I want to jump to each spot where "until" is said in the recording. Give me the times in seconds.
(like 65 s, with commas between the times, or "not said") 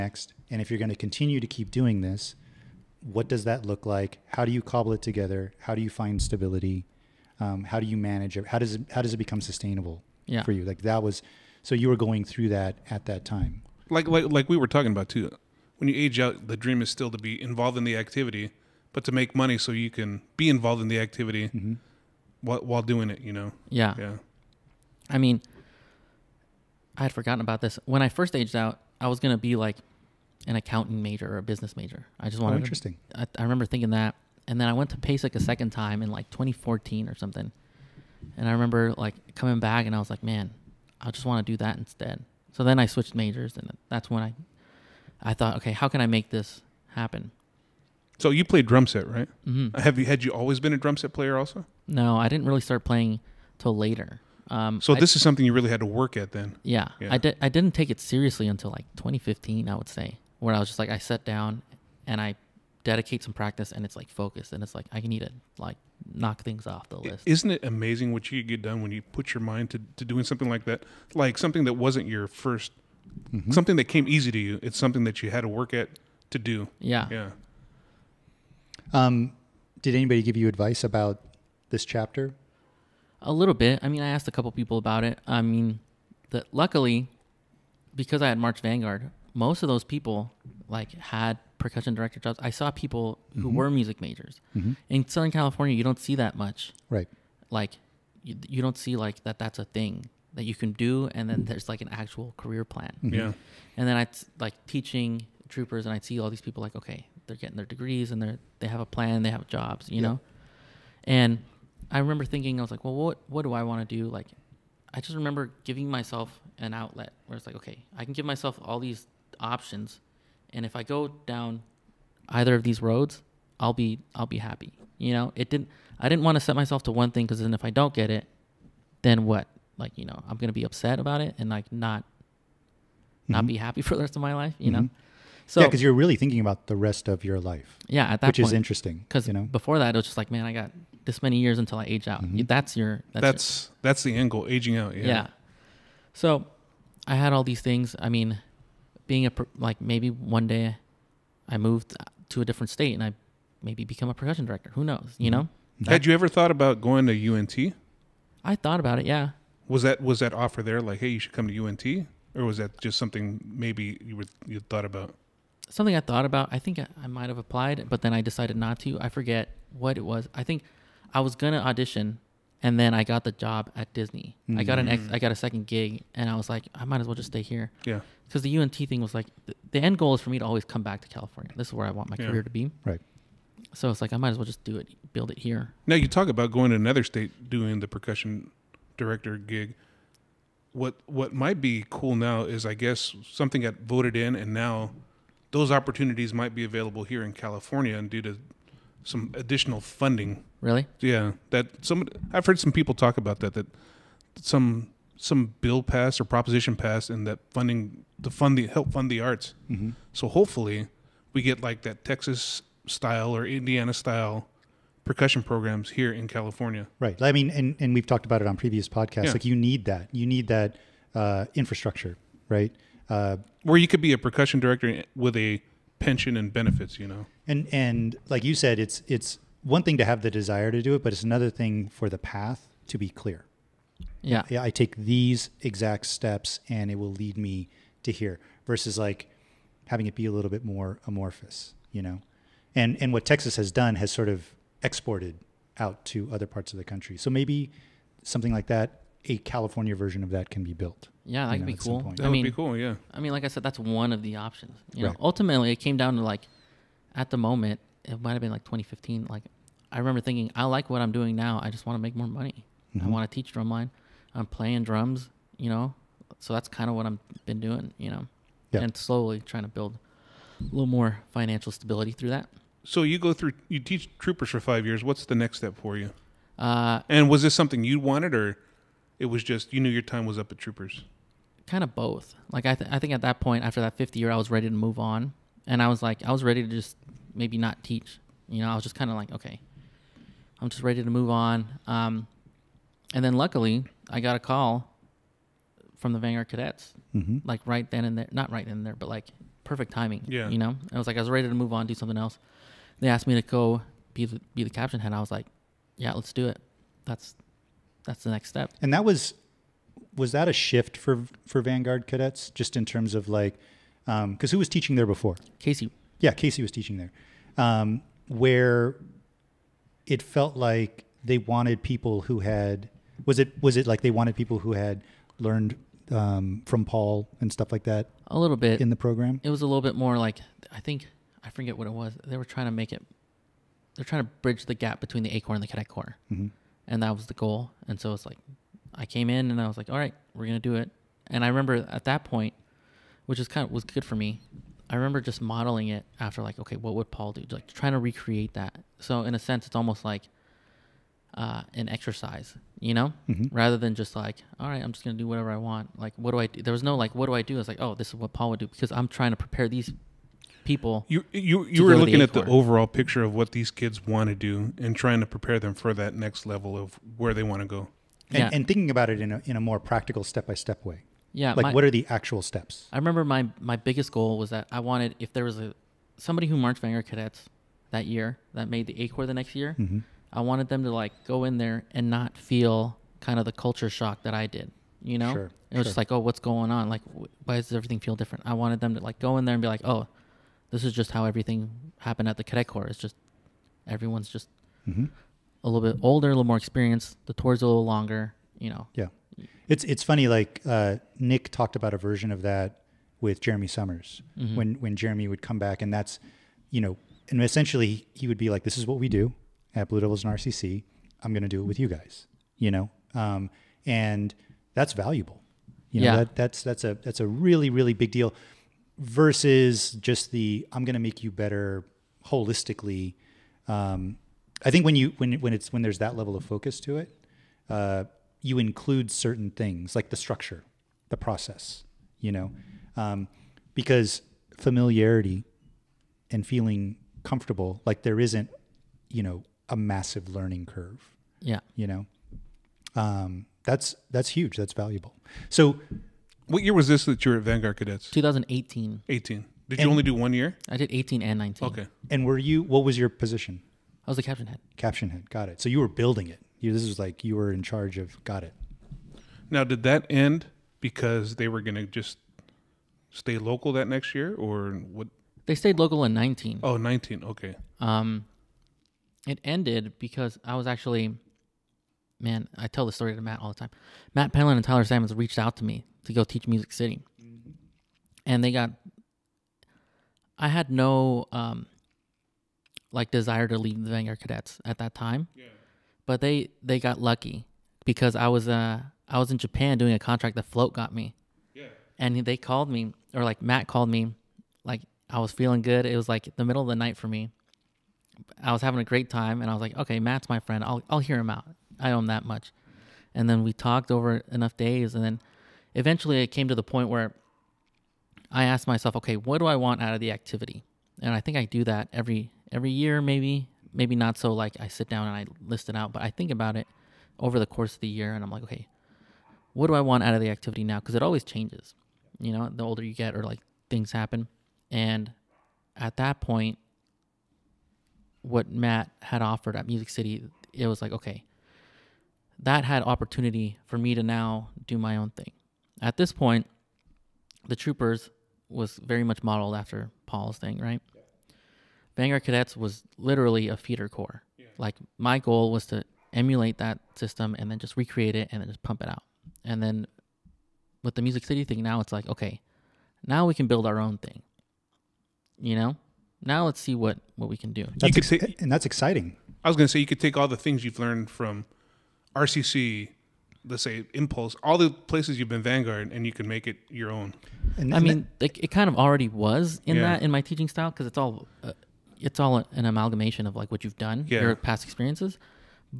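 58 s, 141 s.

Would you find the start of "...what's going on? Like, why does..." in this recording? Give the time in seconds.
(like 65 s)
386 s.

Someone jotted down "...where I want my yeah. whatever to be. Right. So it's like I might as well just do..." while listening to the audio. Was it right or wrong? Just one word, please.
wrong.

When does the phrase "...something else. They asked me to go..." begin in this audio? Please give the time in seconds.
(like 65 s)
301 s.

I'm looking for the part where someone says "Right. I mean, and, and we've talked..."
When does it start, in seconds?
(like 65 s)
216 s.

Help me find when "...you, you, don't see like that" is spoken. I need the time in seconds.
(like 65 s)
98 s.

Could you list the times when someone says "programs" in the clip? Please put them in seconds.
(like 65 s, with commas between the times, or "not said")
215 s, 328 s.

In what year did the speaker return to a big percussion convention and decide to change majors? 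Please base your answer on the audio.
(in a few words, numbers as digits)
2014.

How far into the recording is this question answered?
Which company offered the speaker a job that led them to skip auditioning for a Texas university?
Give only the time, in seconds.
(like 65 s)
173 s.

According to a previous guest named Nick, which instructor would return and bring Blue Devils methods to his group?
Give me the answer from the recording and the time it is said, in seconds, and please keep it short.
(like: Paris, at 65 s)
Jeremy Summers, at 403 s.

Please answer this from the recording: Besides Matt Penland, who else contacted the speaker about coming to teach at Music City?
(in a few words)
Tyler Sammons.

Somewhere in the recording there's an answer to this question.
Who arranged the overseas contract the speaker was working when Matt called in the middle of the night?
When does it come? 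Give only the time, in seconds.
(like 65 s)
490 s.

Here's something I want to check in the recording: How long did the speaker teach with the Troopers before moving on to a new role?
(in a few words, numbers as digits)
Five years.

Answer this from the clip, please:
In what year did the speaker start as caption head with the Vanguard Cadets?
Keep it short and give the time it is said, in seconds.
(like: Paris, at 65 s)
2018, at 448 s.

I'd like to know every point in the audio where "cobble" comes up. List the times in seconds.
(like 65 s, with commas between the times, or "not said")
4 s.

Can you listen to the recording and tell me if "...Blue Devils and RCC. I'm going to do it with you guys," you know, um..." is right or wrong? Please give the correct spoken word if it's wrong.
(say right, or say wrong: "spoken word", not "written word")
right.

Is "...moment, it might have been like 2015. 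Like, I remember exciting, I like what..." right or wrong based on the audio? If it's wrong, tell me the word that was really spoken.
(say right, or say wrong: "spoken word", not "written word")
wrong: "thinking", not "exciting".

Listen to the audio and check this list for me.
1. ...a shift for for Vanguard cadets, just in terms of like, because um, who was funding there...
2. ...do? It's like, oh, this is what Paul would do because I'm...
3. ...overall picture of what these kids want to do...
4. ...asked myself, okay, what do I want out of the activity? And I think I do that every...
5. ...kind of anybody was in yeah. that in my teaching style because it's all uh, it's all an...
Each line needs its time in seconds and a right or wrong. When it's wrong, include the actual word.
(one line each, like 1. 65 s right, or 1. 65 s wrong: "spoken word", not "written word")
1. 310 s wrong: "teaching", not "funding"
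2. 357 s right
3. 362 s right
4. 508 s right
5. 568 s wrong: "already", not "anybody".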